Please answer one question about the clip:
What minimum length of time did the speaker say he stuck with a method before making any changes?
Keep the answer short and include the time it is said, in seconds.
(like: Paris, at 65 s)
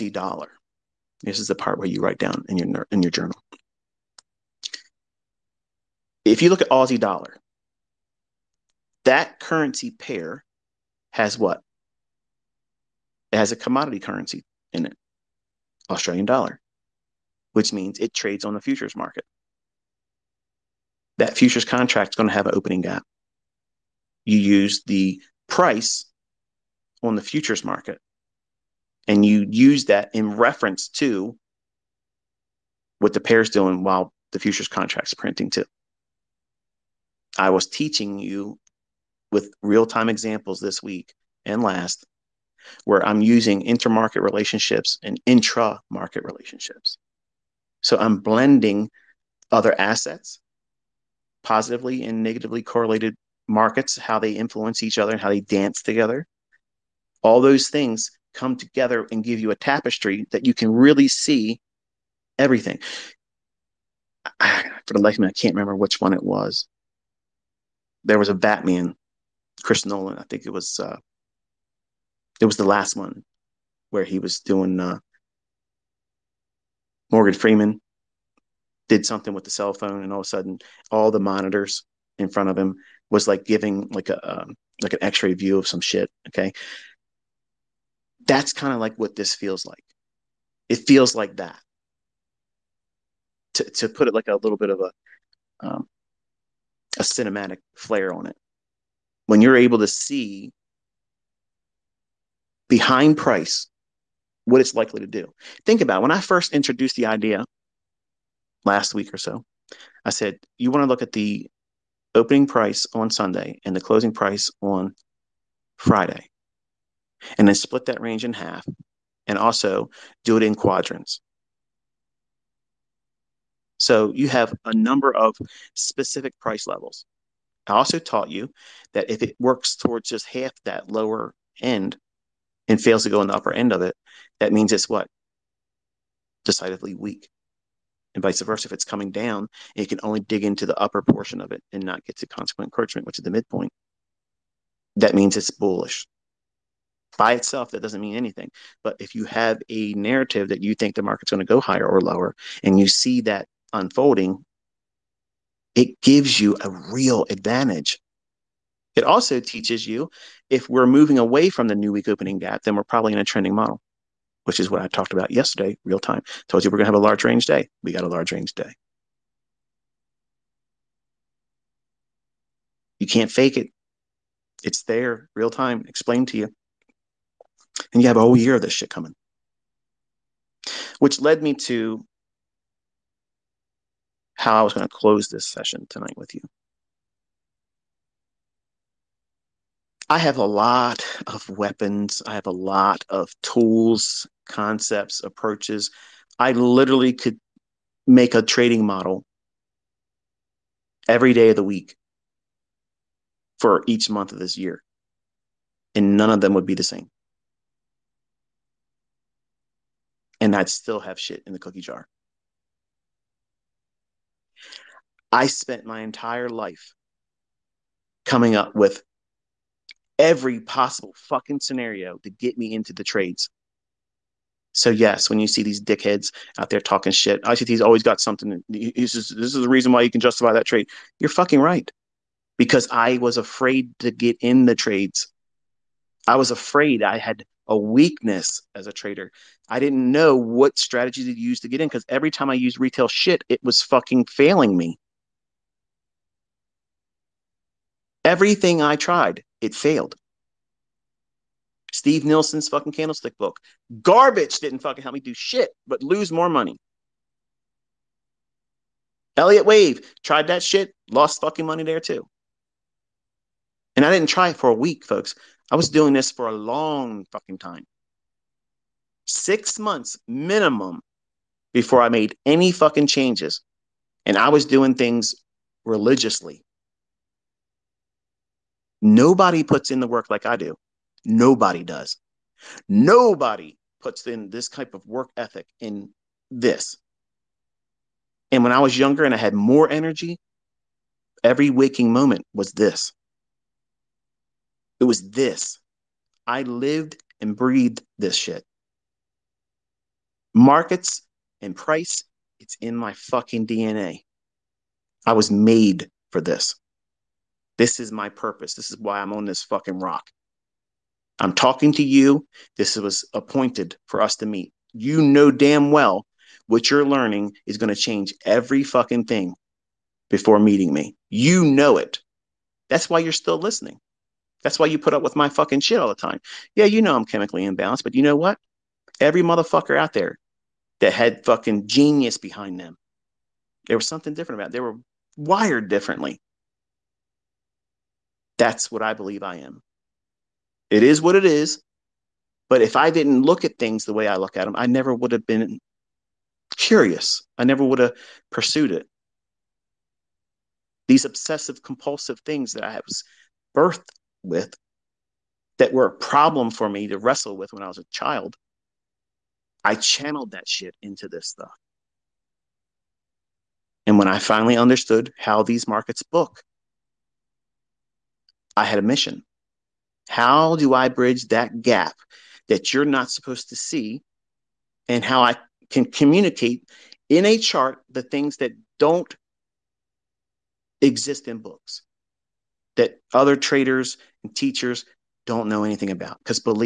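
6 months, at 269 s.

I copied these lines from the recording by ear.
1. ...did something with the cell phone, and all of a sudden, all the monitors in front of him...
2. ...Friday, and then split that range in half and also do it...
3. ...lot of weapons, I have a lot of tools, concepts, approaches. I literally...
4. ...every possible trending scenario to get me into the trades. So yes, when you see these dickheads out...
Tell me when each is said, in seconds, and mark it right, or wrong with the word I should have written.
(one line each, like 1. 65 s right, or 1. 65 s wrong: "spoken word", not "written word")
1. 78 s right
2. 115 s right
3. 190 s right
4. 220 s wrong: "fucking", not "trending".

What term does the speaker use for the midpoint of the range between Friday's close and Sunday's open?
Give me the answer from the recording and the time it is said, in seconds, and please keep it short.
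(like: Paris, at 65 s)
consequent encroachment, at 142 s.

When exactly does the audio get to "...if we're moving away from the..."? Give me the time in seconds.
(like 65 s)
160 s.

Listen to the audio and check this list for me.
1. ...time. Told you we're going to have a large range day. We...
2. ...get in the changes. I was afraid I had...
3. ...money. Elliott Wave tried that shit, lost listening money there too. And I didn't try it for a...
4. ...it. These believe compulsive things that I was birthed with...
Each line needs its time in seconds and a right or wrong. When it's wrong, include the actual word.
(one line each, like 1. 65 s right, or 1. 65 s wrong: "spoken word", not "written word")
1. 165 s right
2. 234 s wrong: "trades", not "changes"
3. 256 s wrong: "fucking", not "listening"
4. 348 s wrong: "obsessive", not "believe".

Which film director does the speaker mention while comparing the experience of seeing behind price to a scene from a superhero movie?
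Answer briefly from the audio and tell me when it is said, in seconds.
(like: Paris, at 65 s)
Chris Nolan, at 69 s.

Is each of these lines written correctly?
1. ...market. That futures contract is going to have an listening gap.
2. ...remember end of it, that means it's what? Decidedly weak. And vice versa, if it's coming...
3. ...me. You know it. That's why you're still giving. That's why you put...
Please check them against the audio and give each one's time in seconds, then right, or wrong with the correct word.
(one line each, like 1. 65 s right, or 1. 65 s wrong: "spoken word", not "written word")
1. 18 s wrong: "opening", not "listening"
2. 133 s wrong: "upper", not "remember"
3. 320 s wrong: "listening", not "giving".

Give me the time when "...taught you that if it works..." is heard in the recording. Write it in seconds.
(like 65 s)
127 s.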